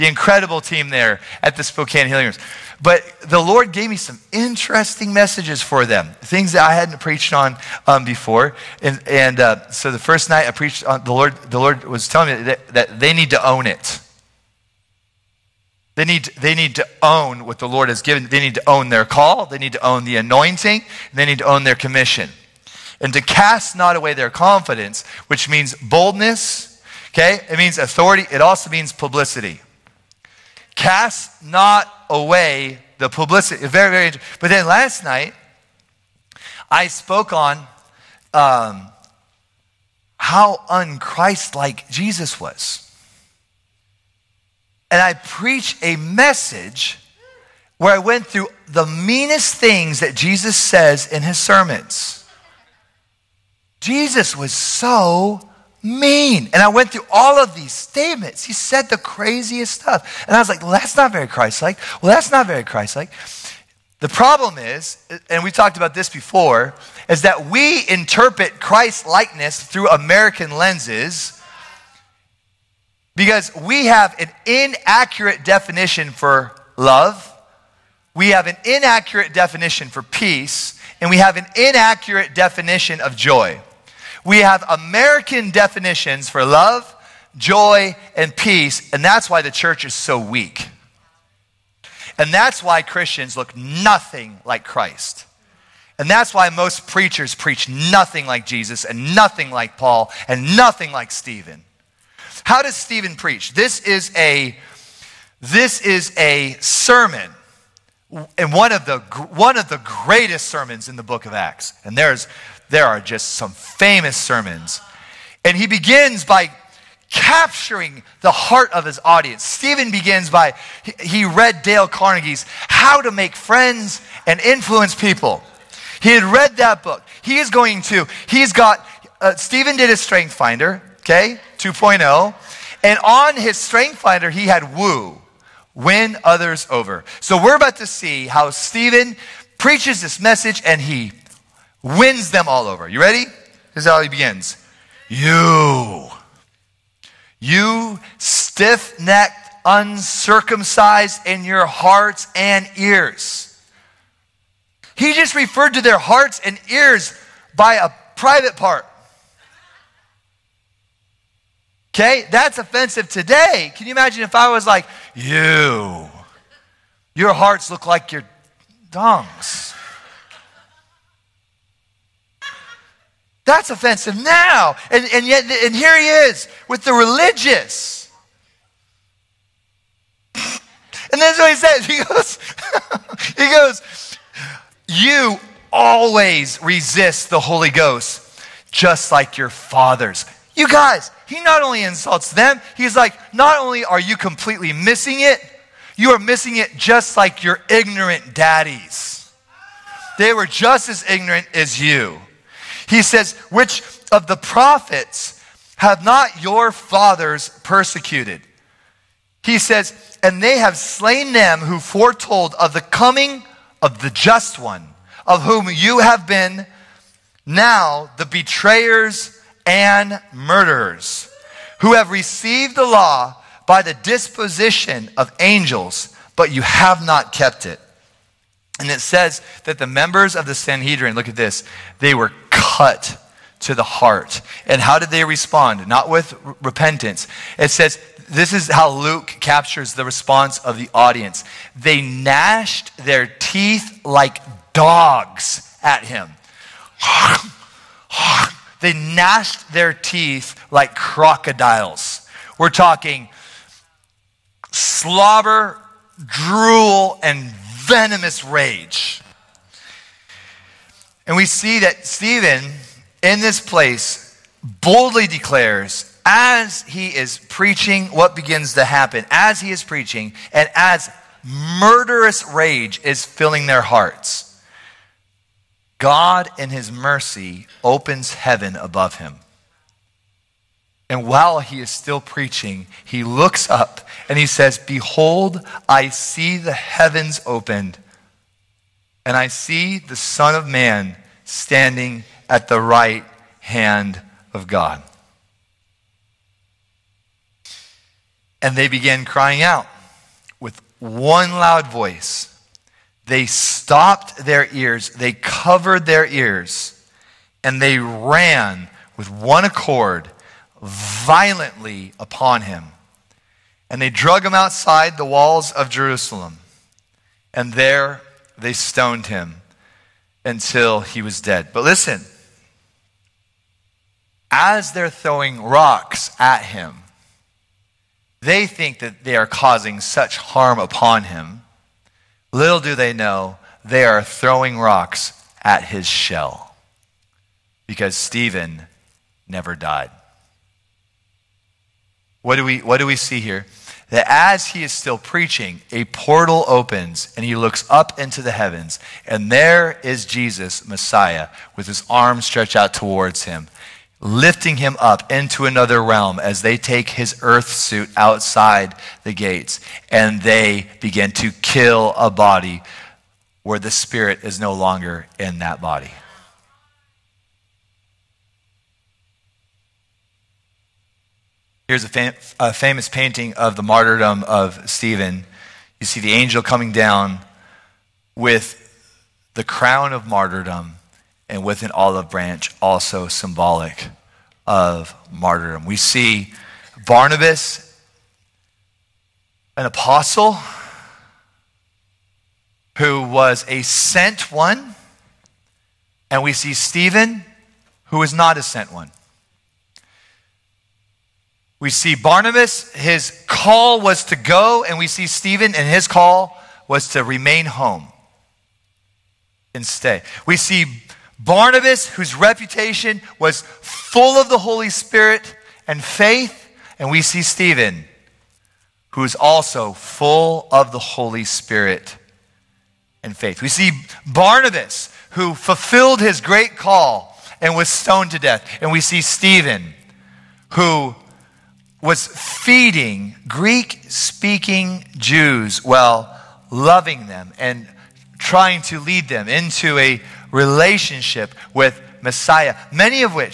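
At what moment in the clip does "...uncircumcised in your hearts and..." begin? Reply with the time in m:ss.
2:29.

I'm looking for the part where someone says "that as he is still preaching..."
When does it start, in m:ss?
5:44.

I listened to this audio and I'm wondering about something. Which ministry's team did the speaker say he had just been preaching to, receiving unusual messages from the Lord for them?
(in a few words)
Spokane Healing Rooms.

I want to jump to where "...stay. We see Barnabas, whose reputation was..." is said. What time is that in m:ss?
6:49.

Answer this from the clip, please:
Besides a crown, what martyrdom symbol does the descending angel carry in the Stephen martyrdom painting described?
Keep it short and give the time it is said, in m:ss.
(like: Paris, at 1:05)
Olive branch, at 6:21.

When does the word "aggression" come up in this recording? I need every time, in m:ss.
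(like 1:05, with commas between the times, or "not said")
not said.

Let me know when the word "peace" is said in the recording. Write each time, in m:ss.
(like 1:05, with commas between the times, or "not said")
1:20, 1:28.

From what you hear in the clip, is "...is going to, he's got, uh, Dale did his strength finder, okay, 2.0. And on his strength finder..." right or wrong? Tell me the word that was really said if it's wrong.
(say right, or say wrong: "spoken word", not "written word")
wrong: "Stephen", not "Dale".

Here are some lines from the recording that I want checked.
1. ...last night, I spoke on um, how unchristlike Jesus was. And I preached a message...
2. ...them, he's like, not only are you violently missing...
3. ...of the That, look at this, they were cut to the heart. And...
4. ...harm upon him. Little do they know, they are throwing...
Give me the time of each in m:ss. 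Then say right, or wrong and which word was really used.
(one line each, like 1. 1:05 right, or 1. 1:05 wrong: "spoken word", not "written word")
1. 0:34 right
2. 3:12 wrong: "completely", not "violently"
3. 3:50 wrong: "Sanhedrin", not "That"
4. 5:30 right.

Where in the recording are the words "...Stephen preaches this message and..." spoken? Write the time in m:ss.
2:18.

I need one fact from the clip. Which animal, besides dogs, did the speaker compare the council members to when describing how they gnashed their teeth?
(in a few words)
Crocodiles.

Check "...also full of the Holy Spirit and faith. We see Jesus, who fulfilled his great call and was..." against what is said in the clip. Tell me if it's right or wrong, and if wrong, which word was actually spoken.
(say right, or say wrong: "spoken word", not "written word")
wrong: "Barnabas", not "Jesus".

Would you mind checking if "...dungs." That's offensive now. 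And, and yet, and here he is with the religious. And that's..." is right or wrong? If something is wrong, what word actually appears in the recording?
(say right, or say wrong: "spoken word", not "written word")
right.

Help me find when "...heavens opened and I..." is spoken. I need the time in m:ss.
4:46.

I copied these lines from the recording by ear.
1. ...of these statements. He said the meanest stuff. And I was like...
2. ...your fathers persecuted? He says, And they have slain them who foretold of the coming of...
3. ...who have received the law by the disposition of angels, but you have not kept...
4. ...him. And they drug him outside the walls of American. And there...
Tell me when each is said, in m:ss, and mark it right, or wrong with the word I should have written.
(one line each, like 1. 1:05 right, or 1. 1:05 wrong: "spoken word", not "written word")
1. 0:57 wrong: "craziest", not "meanest"
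2. 3:26 right
3. 3:41 right
4. 5:12 wrong: "Jerusalem", not "American".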